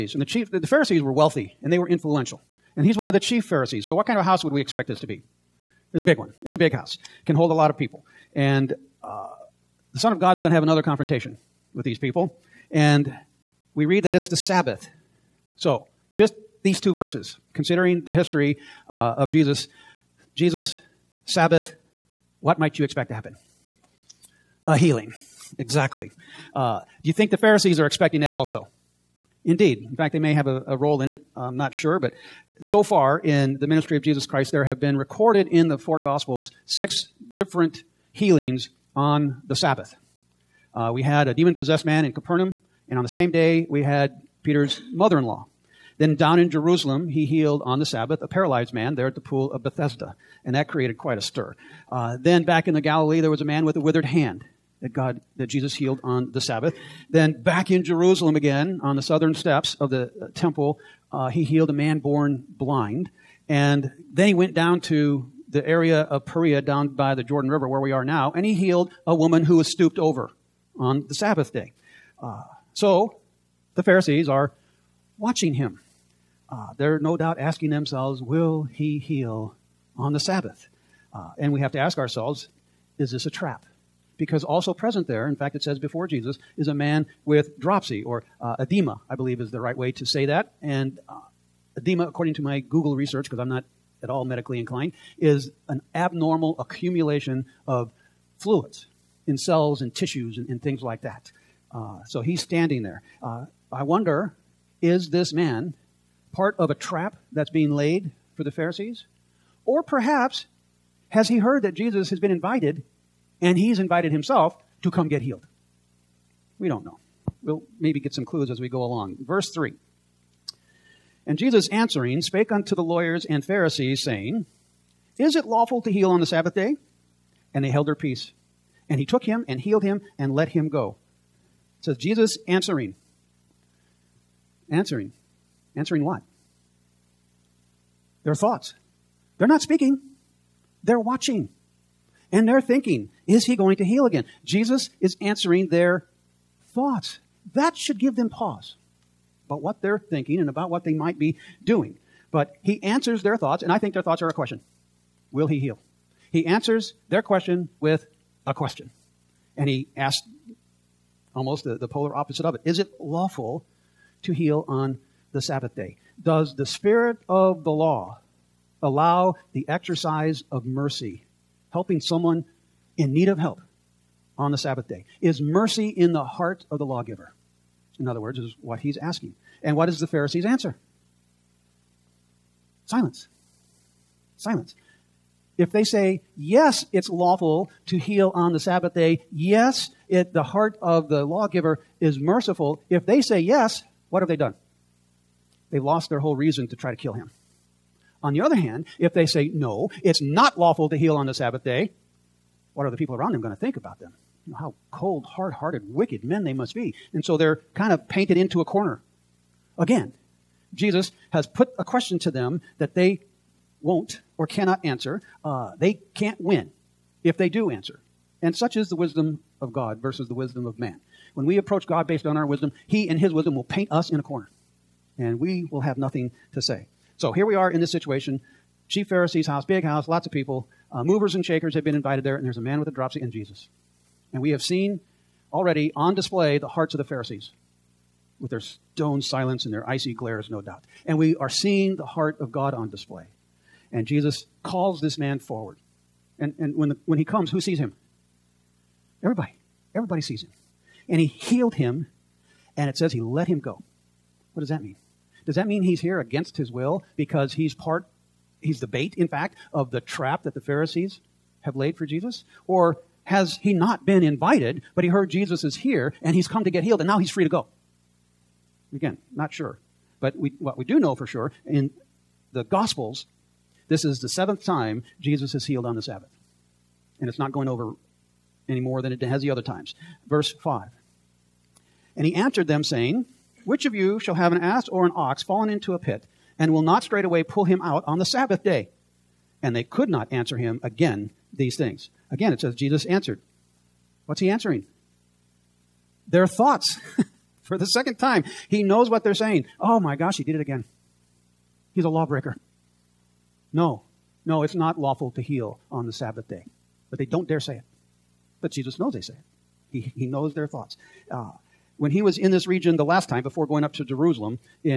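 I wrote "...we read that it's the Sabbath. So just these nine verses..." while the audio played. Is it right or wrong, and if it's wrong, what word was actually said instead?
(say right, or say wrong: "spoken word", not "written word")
wrong: "two", not "nine".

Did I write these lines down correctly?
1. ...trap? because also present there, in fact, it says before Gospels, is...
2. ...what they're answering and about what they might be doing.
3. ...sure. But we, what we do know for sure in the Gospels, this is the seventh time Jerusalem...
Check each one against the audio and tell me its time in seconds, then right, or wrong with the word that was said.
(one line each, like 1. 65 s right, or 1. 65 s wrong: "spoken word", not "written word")
1. 83 s wrong: "Jesus", not "Gospels"
2. 149 s wrong: "thinking", not "answering"
3. 269 s wrong: "Jesus", not "Jerusalem".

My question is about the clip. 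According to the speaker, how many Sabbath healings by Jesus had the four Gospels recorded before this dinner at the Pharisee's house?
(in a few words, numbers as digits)
6.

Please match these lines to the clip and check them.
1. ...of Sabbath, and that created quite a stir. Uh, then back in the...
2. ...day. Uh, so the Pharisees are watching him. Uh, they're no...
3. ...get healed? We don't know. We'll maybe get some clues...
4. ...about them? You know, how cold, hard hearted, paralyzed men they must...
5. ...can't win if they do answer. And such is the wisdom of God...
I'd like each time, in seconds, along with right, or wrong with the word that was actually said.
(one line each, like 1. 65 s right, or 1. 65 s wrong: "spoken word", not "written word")
1. 49 s wrong: "Bethesda", not "Sabbath"
2. 71 s right
3. 115 s right
4. 203 s wrong: "wicked", not "paralyzed"
5. 216 s right.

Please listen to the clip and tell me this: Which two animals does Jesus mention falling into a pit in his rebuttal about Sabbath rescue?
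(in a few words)
an ass or an ox.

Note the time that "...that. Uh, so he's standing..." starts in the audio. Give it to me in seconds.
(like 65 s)
101 s.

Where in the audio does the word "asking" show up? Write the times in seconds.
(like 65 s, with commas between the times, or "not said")
77 s, 178 s.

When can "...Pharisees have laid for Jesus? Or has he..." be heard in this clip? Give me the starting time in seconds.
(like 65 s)
260 s.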